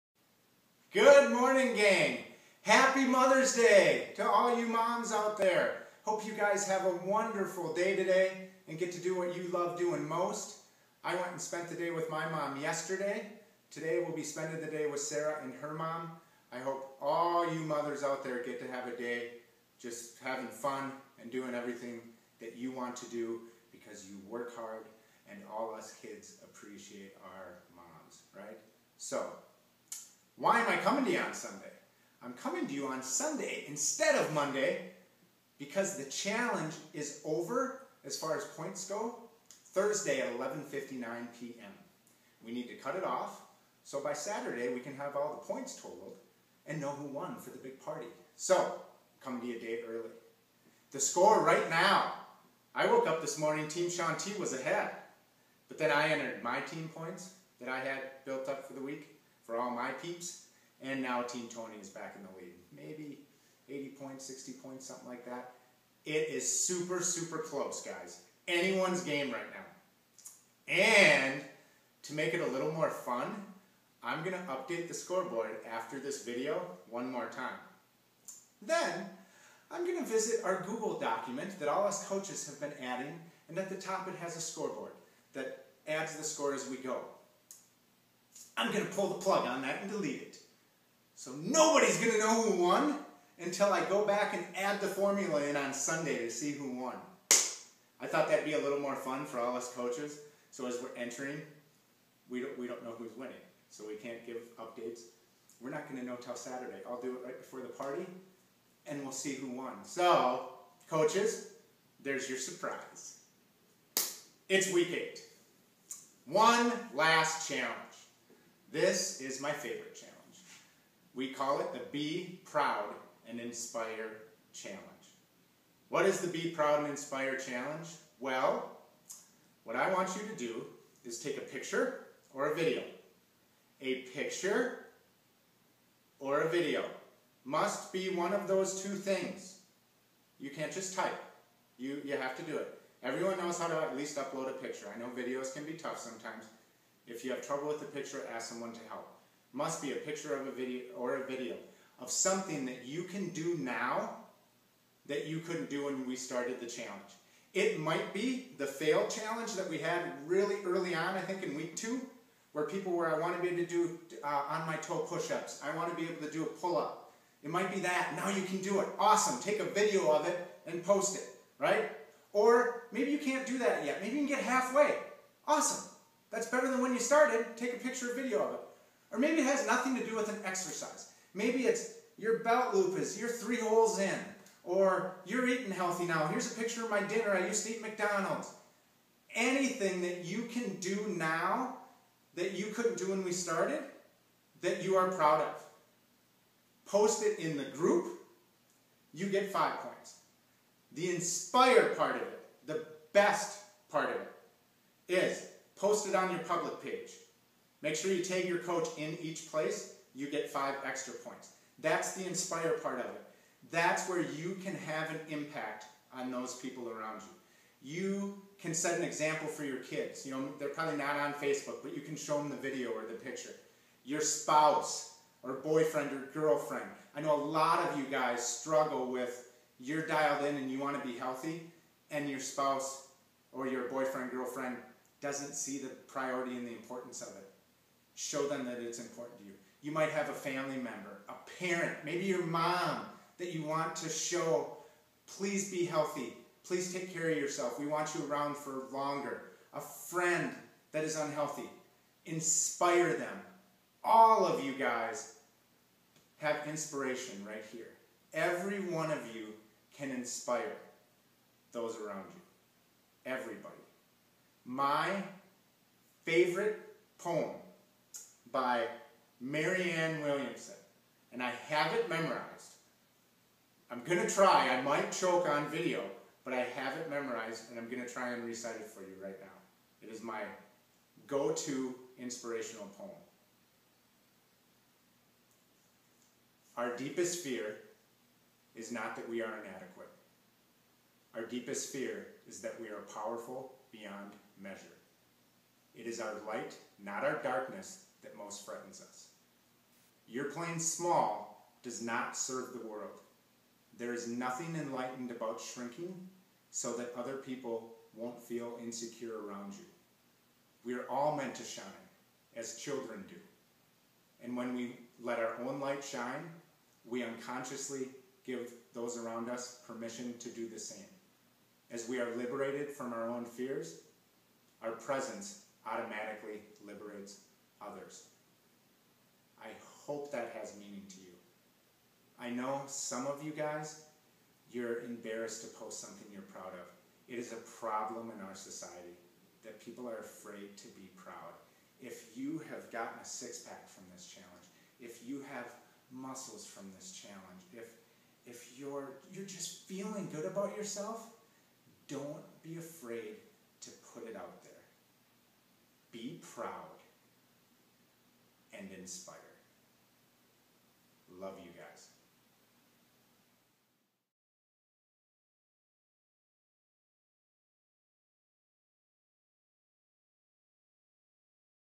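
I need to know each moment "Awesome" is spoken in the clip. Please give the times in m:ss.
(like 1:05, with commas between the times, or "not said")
2:48, 2:55.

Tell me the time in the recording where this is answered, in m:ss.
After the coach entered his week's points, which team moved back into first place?
1:01.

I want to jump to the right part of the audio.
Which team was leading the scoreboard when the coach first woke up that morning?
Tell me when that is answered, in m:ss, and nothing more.
0:53.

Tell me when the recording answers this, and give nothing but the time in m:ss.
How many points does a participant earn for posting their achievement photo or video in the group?
3:19.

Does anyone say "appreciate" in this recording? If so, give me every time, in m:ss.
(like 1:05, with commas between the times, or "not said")
0:26.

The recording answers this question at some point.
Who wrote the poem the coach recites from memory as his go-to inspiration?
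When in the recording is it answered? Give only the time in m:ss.
4:29.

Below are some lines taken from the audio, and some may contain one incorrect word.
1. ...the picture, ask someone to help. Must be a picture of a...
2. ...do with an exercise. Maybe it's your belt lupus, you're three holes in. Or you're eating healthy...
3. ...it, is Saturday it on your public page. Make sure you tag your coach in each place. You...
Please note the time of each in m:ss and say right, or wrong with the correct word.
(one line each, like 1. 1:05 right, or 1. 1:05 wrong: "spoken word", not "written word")
1. 2:27 right
2. 3:00 right
3. 3:24 wrong: "Post", not "Saturday".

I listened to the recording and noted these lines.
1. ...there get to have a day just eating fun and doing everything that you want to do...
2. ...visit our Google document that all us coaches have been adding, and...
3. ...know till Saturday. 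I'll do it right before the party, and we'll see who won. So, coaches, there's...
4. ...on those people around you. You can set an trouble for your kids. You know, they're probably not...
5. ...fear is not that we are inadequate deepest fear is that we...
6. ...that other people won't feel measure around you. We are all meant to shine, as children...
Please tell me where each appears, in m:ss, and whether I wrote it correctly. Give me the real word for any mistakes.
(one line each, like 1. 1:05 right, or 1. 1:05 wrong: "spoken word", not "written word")
1. 0:18 wrong: "having", not "eating"
2. 1:20 right
3. 1:46 right
4. 3:36 wrong: "example", not "trouble"
5. 4:47 right
6. 5:06 wrong: "insecure", not "measure".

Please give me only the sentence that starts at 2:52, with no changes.
Or maybe you can't do that yet.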